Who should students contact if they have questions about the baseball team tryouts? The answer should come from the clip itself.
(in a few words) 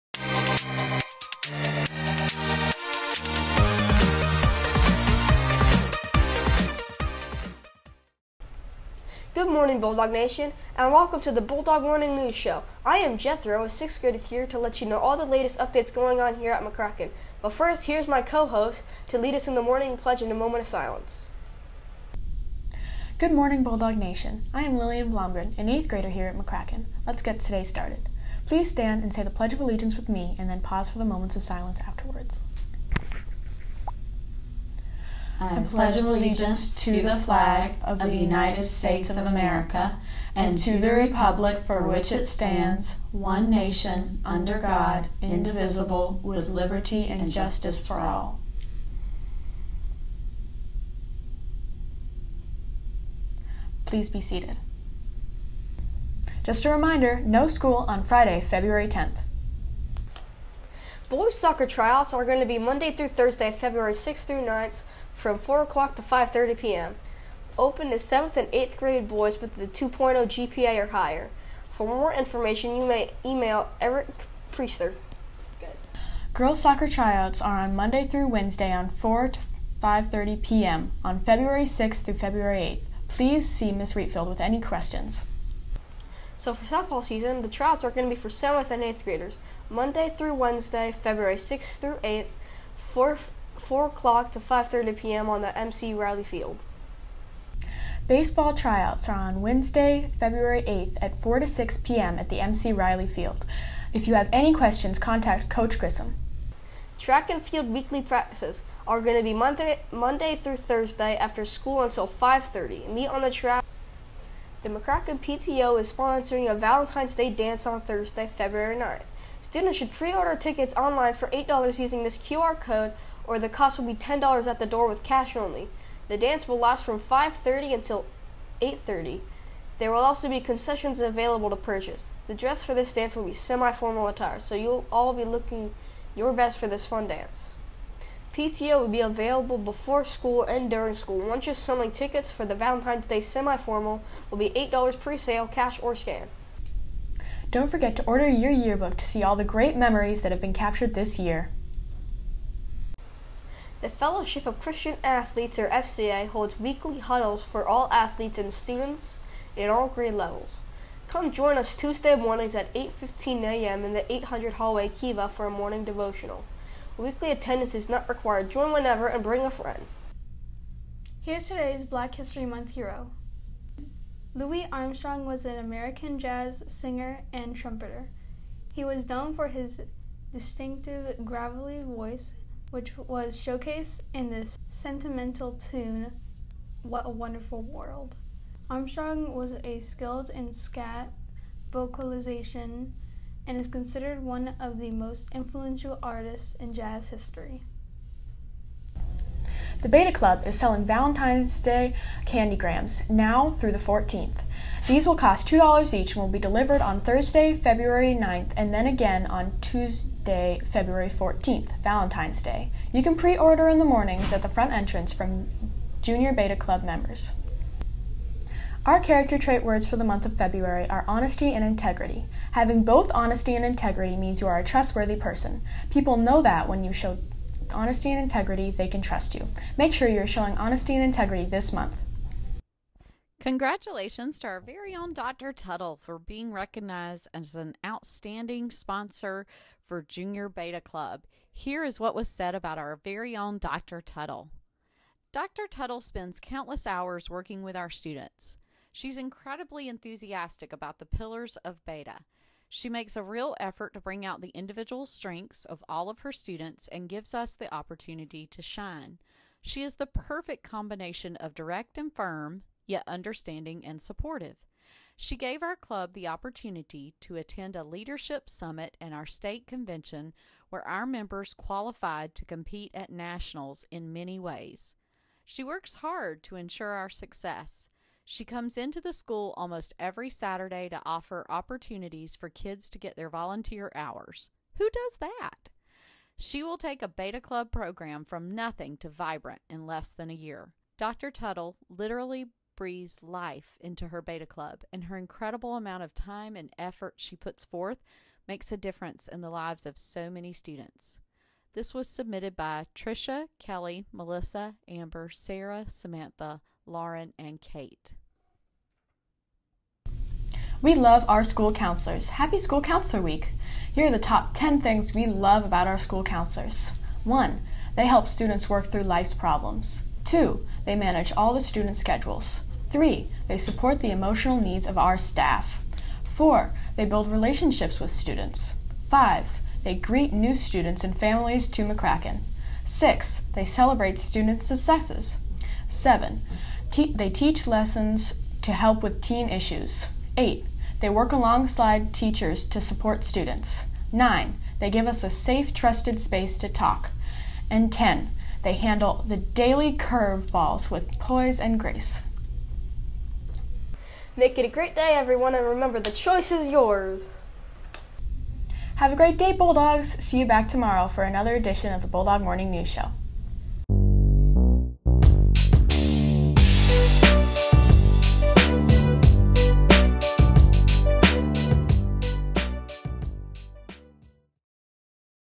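Coach Grissom.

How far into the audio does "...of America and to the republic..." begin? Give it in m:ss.
0:39.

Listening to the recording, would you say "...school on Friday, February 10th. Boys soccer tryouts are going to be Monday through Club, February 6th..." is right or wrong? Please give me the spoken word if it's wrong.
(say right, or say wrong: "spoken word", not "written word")
wrong: "Thursday", not "Club".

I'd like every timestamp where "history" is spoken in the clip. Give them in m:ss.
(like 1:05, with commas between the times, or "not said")
2:52, 3:17.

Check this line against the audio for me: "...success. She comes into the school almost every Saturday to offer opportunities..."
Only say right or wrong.
right.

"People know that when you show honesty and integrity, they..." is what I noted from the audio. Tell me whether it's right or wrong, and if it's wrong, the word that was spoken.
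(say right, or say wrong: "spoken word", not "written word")
right.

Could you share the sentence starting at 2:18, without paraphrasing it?
PTO will be available before school and during school.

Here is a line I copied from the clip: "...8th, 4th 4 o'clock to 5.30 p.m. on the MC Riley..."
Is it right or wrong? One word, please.
right.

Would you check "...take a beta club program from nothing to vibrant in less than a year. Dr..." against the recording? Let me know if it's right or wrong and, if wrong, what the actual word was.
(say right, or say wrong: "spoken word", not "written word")
right.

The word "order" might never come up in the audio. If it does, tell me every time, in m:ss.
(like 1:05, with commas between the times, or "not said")
1:59, 2:28, 3:33.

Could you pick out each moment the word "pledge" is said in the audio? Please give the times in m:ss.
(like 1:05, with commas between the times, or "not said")
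0:19, 0:29, 0:35.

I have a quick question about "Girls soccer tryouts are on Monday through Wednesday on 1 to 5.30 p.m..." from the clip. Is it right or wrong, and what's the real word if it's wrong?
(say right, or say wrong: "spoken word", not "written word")
wrong: "4", not "1".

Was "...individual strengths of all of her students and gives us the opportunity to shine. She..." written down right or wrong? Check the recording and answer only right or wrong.
right.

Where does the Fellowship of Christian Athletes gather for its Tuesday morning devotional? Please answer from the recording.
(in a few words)
800 hallway Kiva.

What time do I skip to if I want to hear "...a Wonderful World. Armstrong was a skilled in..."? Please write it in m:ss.
3:07.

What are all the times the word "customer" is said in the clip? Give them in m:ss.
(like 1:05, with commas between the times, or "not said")
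not said.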